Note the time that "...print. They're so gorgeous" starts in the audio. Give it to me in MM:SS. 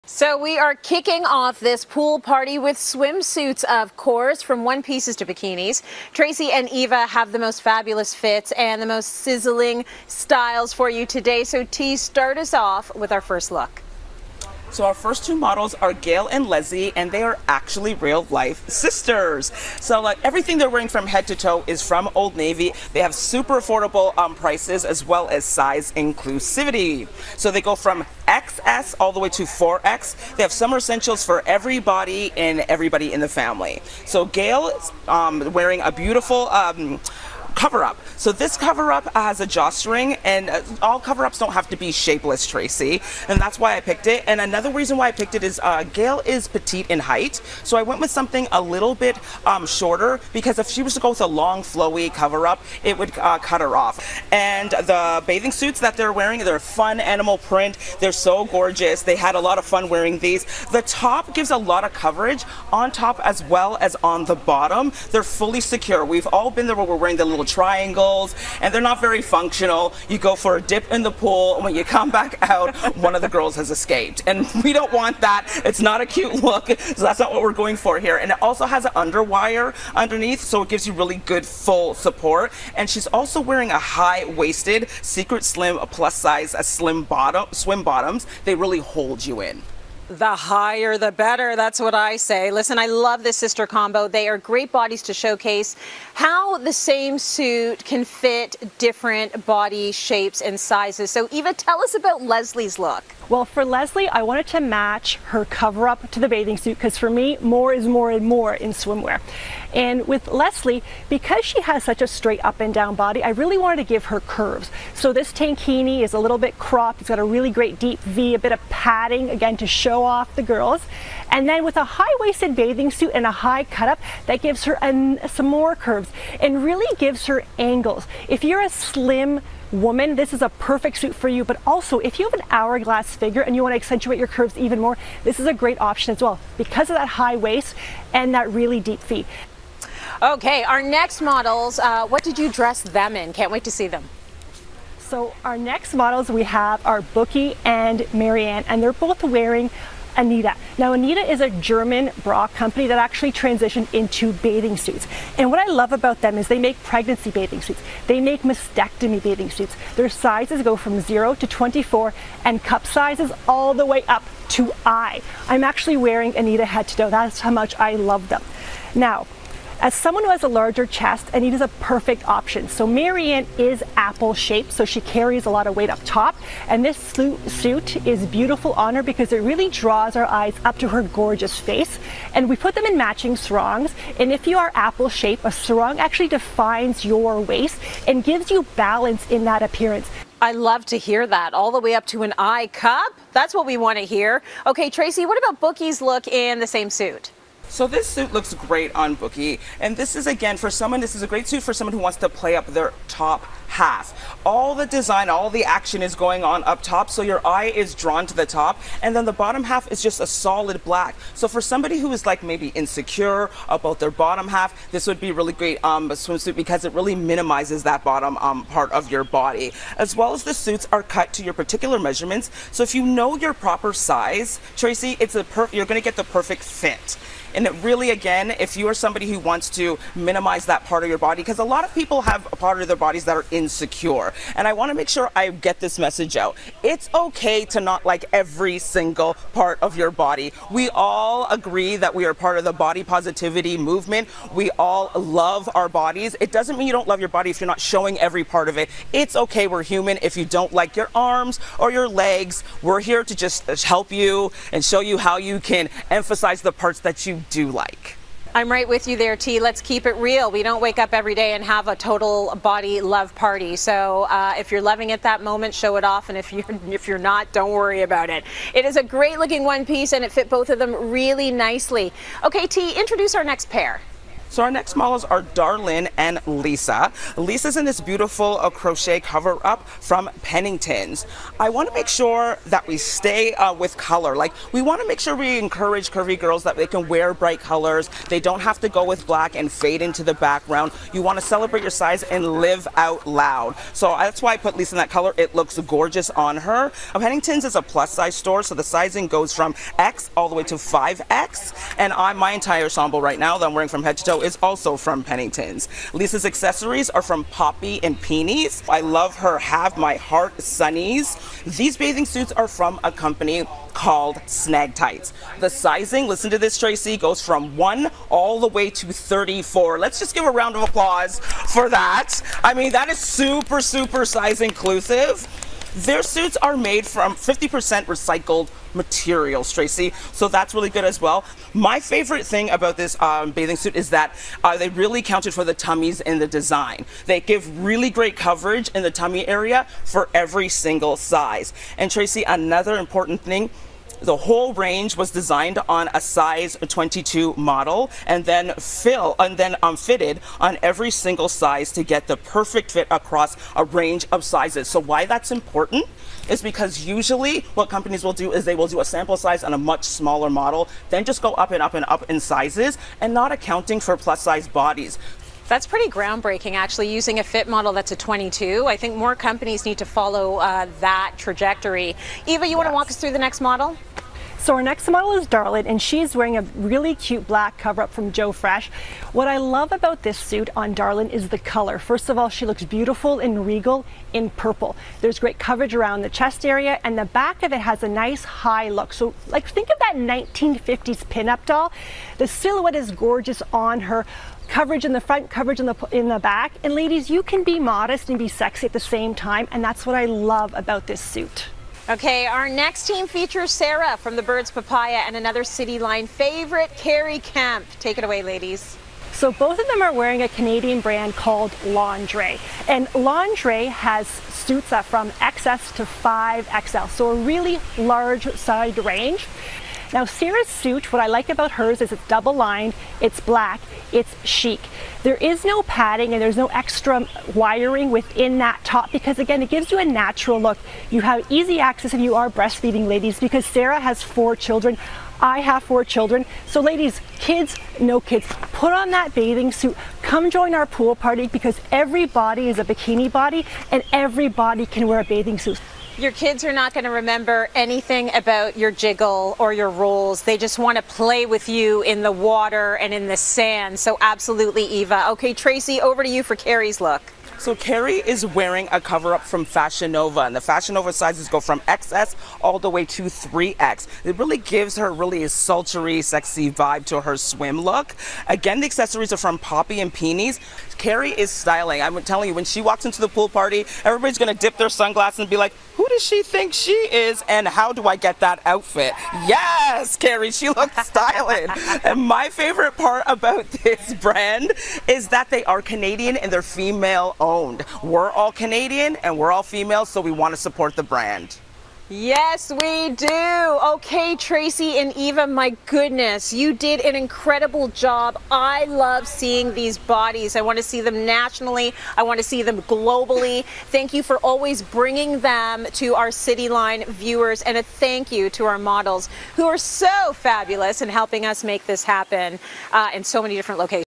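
00:57.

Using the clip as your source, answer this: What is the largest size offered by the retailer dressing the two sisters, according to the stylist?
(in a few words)
4X.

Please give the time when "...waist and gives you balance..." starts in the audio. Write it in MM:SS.
03:07.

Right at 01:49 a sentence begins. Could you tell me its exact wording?
And with Leslie, because she has such a straight up and down body, I really wanted to give her curves.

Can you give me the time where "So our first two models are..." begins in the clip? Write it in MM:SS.
00:14.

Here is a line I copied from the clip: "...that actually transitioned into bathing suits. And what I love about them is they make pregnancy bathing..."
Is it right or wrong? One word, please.
right.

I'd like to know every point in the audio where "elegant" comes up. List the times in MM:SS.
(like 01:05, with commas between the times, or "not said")
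not said.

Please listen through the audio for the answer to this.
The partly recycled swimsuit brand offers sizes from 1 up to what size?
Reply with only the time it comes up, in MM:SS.
05:19.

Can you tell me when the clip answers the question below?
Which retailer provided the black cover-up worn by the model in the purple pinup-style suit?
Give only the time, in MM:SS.
06:18.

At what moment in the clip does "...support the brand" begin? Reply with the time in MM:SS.
08:10.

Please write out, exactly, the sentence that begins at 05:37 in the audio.
They give really great coverage in the tummy area for every single size.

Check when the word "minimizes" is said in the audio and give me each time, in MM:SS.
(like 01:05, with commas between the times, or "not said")
03:37, 03:50.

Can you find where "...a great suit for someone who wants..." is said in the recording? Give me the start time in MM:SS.
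03:21.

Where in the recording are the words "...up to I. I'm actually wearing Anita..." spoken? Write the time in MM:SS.
02:44.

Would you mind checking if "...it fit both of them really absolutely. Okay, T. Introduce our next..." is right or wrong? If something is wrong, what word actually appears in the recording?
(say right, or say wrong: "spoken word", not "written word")
wrong: "nicely", not "absolutely".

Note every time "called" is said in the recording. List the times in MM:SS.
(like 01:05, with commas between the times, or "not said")
05:13, 06:51.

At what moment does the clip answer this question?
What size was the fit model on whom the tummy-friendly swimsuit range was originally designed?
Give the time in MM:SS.
05:46.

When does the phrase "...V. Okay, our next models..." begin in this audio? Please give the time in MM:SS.
02:19.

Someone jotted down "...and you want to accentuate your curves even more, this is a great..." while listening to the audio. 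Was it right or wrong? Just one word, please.
right.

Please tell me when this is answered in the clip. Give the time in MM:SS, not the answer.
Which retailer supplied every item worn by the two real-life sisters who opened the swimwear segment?
00:22.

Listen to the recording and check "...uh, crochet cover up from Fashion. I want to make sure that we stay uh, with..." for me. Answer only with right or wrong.
wrong.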